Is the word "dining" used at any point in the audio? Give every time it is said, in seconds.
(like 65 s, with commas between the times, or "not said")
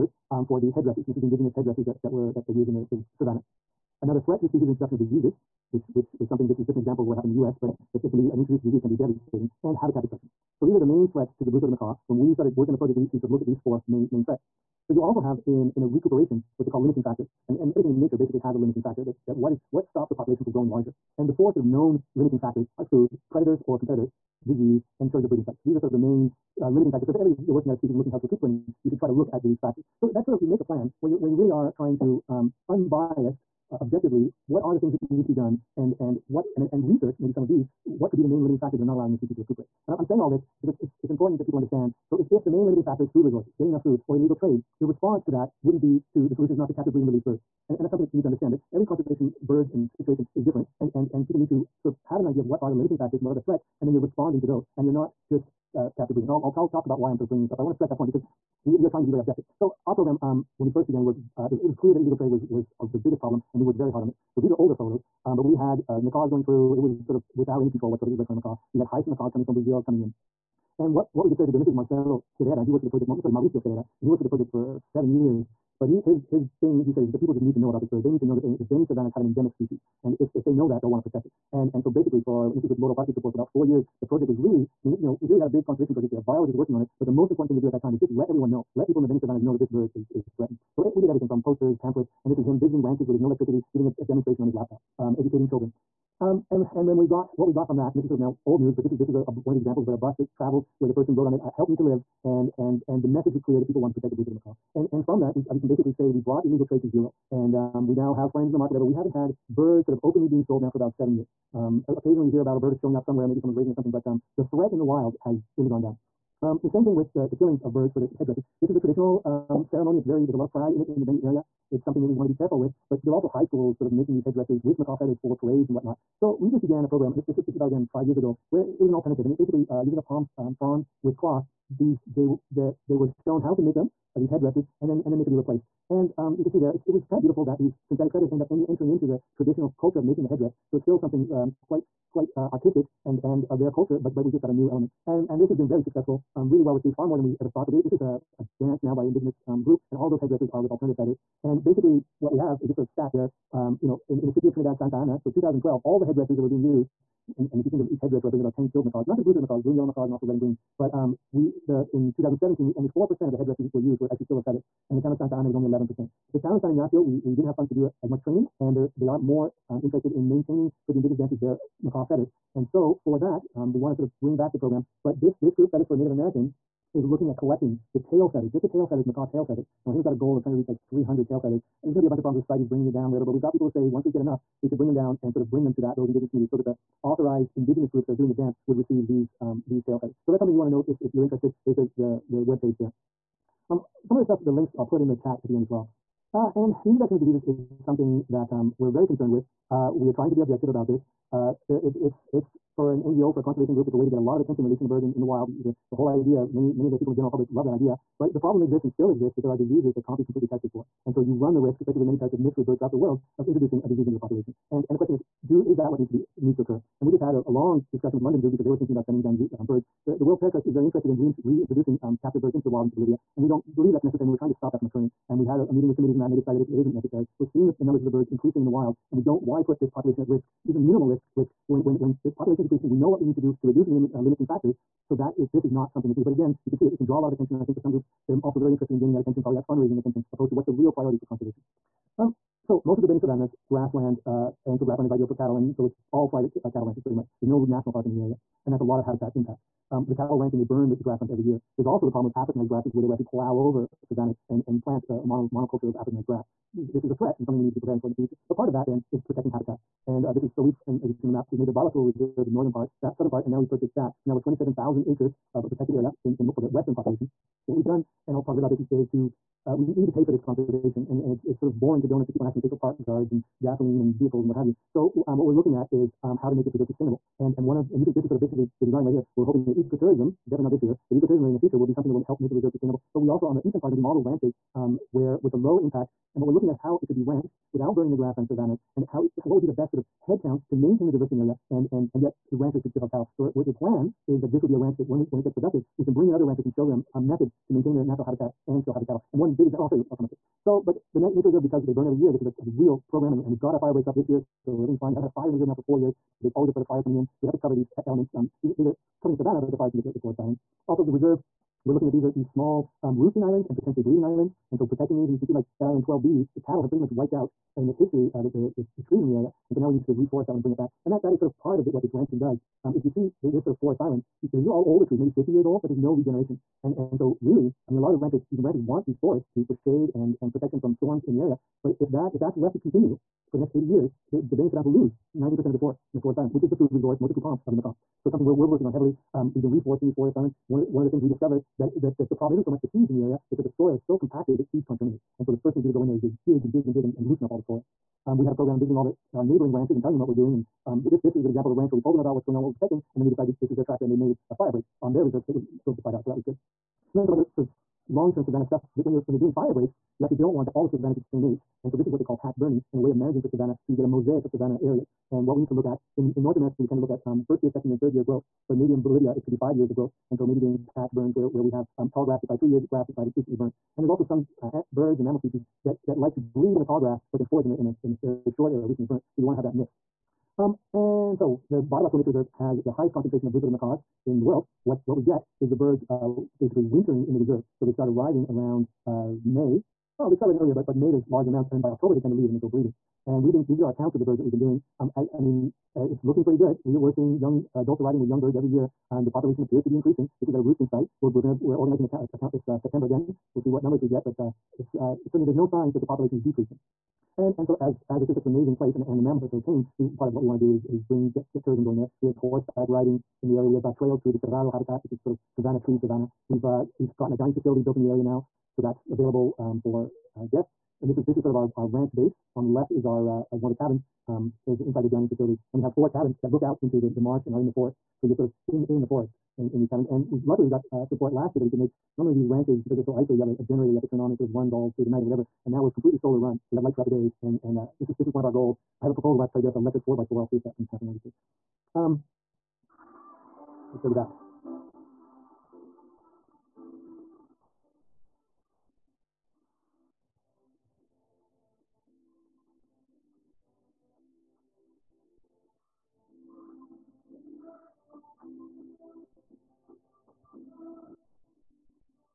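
417 s, 425 s.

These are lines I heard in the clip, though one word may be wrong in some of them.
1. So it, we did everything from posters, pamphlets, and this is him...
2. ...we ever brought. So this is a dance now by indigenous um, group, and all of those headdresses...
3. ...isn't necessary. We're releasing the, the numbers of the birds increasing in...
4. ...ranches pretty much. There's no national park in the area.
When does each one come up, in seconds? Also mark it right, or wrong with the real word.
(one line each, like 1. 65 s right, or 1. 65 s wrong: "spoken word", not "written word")
1. 90 s right
2. 147 s wrong: "thought", not "brought"
3. 226 s wrong: "seeing", not "releasing"
4. 246 s right.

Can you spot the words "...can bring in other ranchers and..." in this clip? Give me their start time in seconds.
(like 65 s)
296 s.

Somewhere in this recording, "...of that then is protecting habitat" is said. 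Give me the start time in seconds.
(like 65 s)
258 s.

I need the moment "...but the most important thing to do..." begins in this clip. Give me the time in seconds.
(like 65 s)
87 s.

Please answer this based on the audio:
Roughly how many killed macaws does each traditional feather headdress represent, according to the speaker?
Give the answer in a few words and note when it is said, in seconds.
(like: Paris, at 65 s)
10, at 158 s.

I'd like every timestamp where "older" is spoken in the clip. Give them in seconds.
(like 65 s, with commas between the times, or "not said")
64 s, 324 s.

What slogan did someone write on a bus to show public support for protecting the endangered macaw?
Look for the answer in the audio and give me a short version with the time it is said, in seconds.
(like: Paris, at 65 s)
Help me to live, at 101 s.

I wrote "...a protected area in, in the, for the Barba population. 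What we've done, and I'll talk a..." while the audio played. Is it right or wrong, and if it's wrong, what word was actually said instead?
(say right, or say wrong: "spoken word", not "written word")
wrong: "Western", not "Barba".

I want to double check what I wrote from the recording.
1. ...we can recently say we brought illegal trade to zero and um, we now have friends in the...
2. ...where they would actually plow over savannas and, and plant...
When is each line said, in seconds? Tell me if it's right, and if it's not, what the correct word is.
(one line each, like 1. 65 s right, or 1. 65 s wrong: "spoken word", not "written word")
1. 105 s wrong: "basically", not "recently"
2. 252 s right.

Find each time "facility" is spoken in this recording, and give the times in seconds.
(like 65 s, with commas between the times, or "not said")
417 s, 425 s.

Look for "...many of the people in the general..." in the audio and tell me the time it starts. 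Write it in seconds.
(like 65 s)
206 s.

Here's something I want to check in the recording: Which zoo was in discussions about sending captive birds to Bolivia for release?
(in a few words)
London Zoo.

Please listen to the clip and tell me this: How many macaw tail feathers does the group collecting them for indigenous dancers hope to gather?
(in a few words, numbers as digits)
300.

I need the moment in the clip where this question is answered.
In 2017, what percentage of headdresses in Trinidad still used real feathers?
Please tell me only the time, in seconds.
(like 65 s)
162 s.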